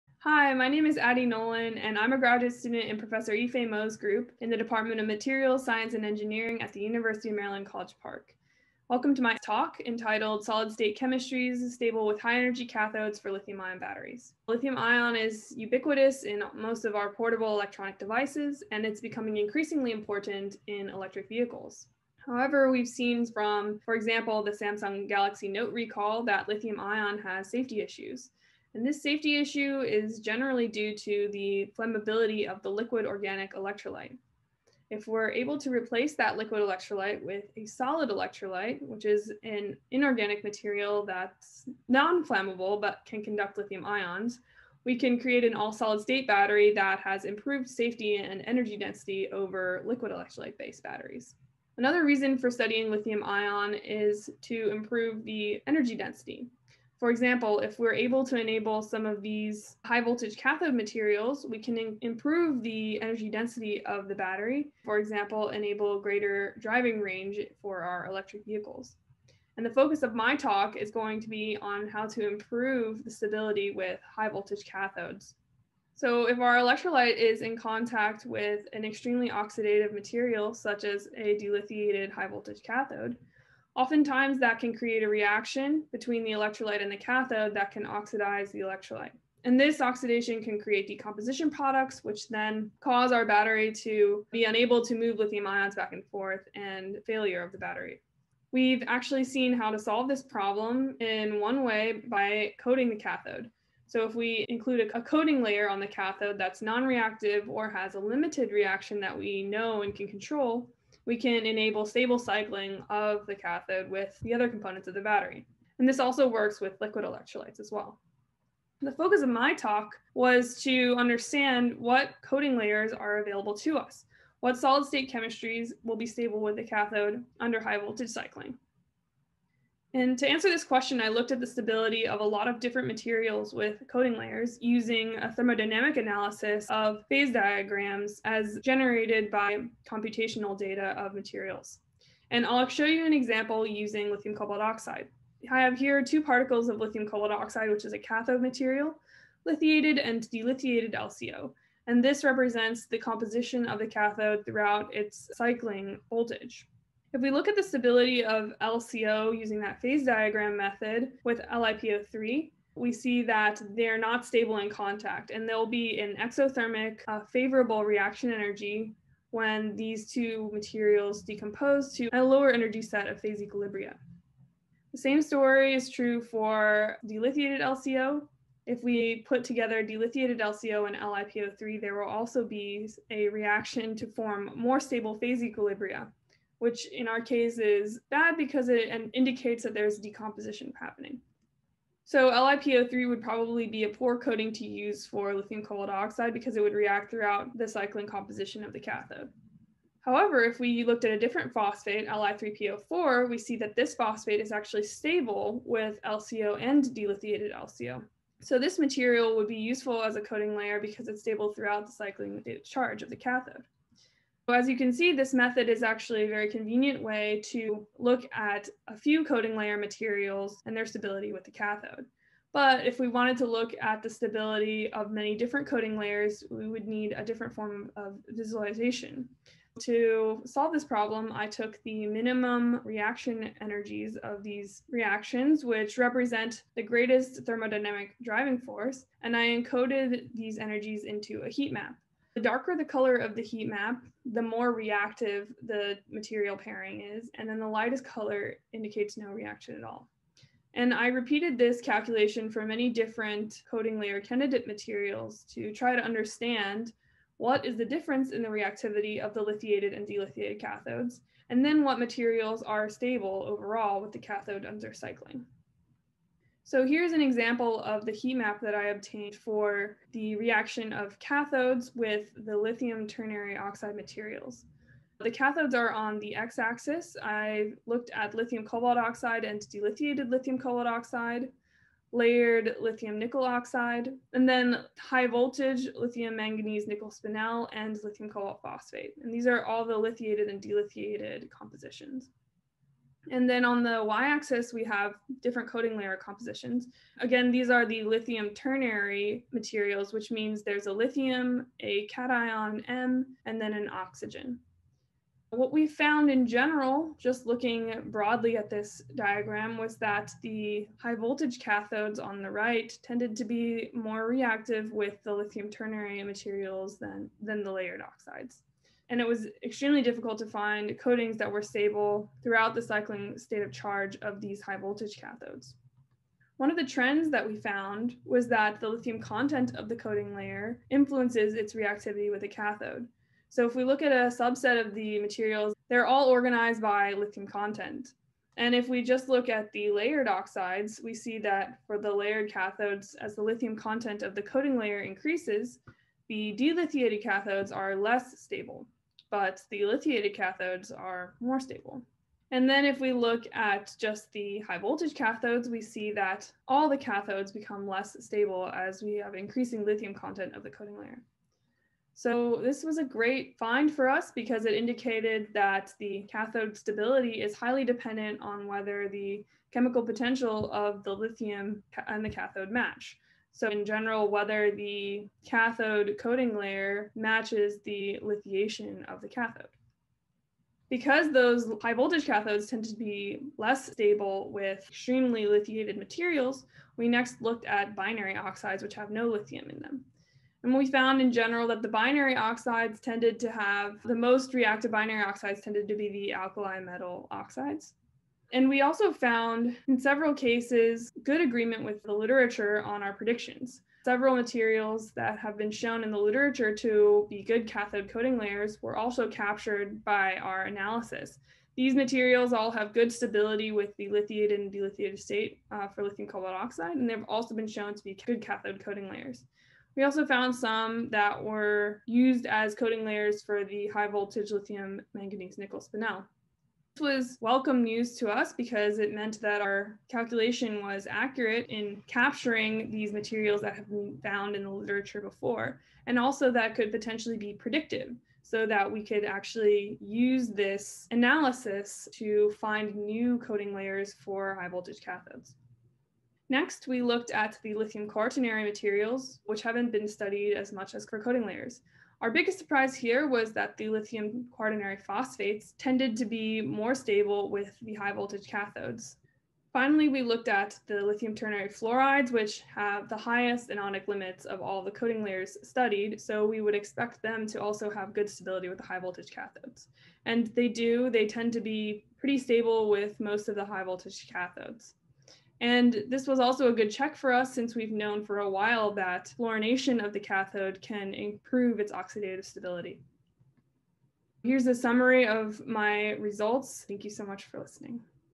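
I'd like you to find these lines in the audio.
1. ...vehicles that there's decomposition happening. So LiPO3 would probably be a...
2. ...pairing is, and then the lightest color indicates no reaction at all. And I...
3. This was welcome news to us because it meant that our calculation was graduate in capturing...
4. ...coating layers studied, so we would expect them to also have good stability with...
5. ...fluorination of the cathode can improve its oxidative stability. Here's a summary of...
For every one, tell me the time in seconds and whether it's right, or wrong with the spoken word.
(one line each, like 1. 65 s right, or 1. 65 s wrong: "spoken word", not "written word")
1. 189 s wrong: "indicates", not "vehicles"
2. 246 s right
3. 426 s wrong: "accurate", not "graduate"
4. 464 s right
5. 479 s right.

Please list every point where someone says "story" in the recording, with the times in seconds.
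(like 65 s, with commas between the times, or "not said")
175 s.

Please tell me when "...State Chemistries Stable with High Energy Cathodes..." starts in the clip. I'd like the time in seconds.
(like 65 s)
10 s.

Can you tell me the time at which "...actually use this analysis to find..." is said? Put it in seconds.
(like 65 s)
439 s.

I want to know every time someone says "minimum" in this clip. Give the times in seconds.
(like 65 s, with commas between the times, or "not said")
232 s.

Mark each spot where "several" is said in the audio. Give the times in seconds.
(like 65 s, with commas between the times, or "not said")
399 s, 404 s.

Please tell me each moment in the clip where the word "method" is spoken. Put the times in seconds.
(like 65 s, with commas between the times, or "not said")
160 s, 215 s.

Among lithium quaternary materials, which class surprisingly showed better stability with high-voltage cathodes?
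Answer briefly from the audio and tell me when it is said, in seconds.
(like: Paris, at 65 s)
Lithium quaternary phosphates, at 453 s.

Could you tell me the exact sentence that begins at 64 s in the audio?
For example, enable greater driving range for our electric vehicles.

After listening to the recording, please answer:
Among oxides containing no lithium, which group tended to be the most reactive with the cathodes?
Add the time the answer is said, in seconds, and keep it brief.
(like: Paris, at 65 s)
Alkali metal oxides, at 396 s.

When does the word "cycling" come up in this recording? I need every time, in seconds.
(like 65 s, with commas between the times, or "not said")
112 s, 128 s, 155 s, 197 s, 211 s, 264 s, 322 s.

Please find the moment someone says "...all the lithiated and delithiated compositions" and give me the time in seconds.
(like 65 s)
289 s.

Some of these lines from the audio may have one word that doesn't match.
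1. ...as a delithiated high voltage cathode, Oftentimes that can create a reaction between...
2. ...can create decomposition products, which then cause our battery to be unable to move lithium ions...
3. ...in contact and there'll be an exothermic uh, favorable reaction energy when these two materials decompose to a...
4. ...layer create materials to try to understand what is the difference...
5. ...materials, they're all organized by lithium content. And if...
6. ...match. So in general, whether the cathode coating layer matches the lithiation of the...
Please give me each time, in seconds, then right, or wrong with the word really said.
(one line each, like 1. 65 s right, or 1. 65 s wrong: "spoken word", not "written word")
1. 80 s right
2. 90 s right
3. 164 s right
4. 253 s wrong: "candidate", not "create"
5. 335 s right
6. 372 s right.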